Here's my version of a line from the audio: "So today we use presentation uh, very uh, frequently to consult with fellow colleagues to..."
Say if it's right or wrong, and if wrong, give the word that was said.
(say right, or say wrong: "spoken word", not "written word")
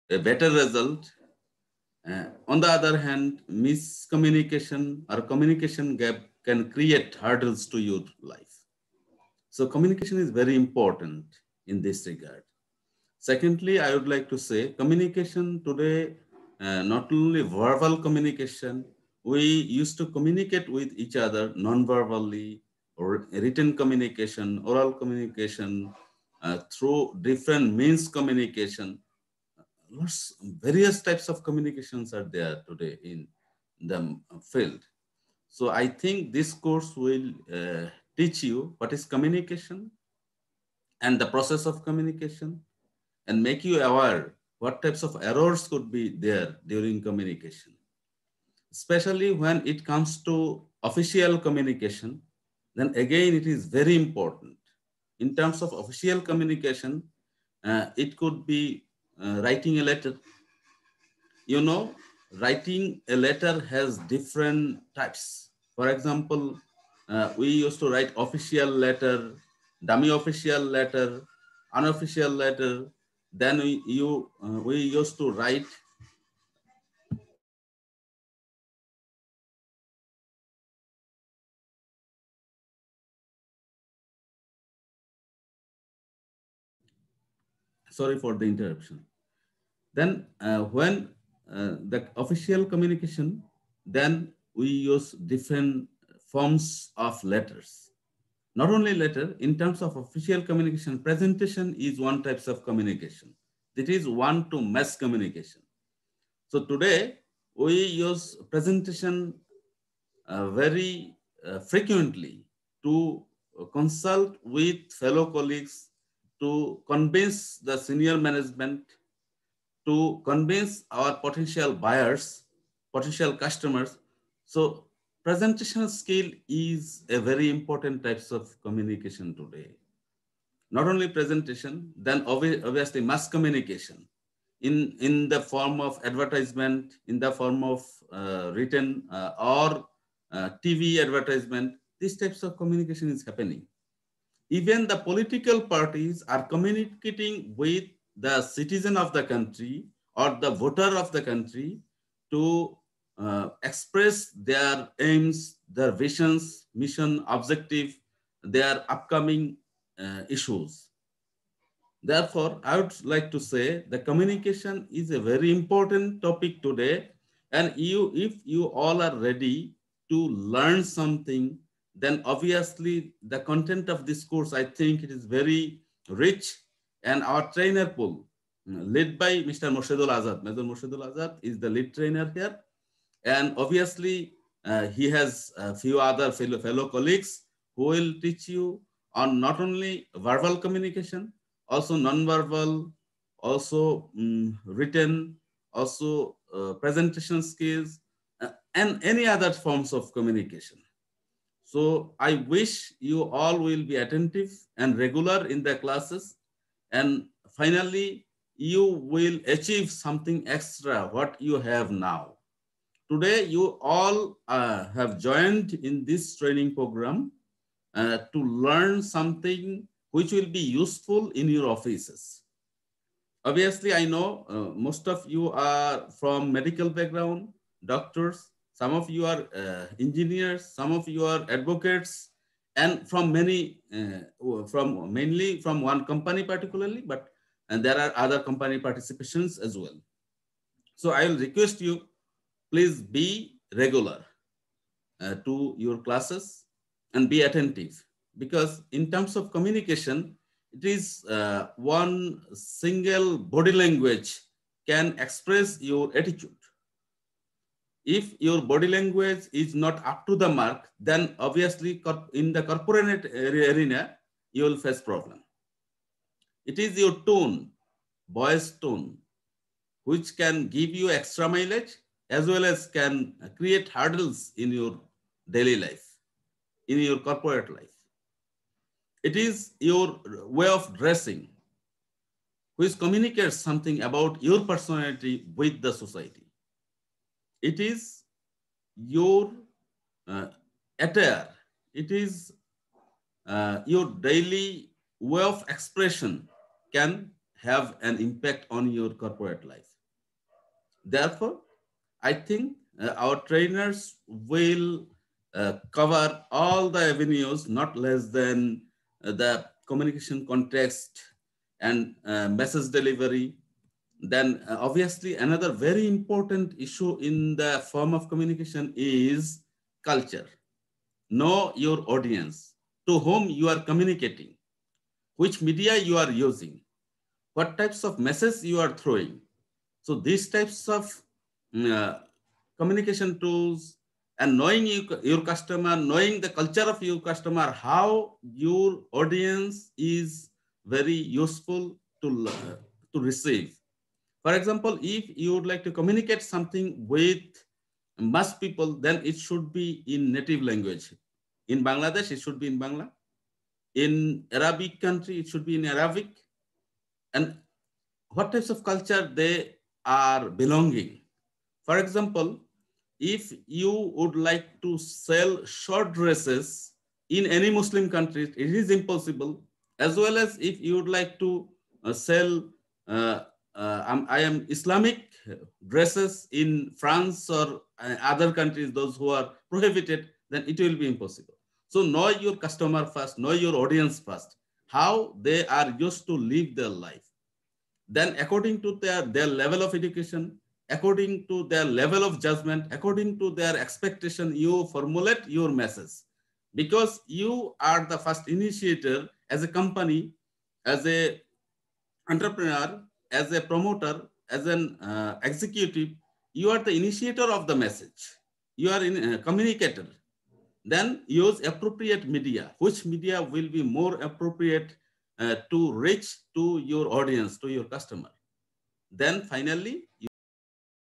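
right.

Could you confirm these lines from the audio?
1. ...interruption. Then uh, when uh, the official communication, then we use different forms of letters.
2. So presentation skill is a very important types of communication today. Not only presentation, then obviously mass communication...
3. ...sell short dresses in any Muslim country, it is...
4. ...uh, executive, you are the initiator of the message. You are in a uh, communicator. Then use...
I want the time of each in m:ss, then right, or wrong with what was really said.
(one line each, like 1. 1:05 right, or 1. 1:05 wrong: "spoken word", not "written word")
1. 1:28 right
2. 2:04 right
3. 6:04 right
4. 6:45 right.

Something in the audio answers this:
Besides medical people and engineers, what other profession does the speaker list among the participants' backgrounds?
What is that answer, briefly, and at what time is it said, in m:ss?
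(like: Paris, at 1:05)
Advocates, at 3:51.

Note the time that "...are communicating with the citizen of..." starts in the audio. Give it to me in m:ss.
2:26.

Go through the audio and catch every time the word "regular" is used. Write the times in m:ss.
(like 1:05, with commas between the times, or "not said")
3:24, 4:03.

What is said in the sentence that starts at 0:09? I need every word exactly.
So communication is very important in this regard.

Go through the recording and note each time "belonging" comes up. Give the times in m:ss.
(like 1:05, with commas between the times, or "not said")
6:00.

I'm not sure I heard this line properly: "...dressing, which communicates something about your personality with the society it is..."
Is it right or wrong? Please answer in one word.
right.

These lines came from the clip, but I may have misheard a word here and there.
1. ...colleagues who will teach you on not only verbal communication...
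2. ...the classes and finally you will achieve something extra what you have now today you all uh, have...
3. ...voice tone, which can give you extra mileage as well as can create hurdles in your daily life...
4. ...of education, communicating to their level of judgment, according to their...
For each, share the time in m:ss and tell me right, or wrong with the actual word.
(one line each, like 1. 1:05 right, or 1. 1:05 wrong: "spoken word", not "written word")
1. 3:06 right
2. 3:25 right
3. 4:28 right
4. 6:29 wrong: "according", not "communicating".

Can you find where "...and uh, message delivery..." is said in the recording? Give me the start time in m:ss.
5:11.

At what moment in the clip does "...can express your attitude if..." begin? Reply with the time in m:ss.
4:14.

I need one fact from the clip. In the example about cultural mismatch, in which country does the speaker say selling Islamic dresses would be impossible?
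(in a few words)
France.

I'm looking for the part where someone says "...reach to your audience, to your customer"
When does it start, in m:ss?
6:55.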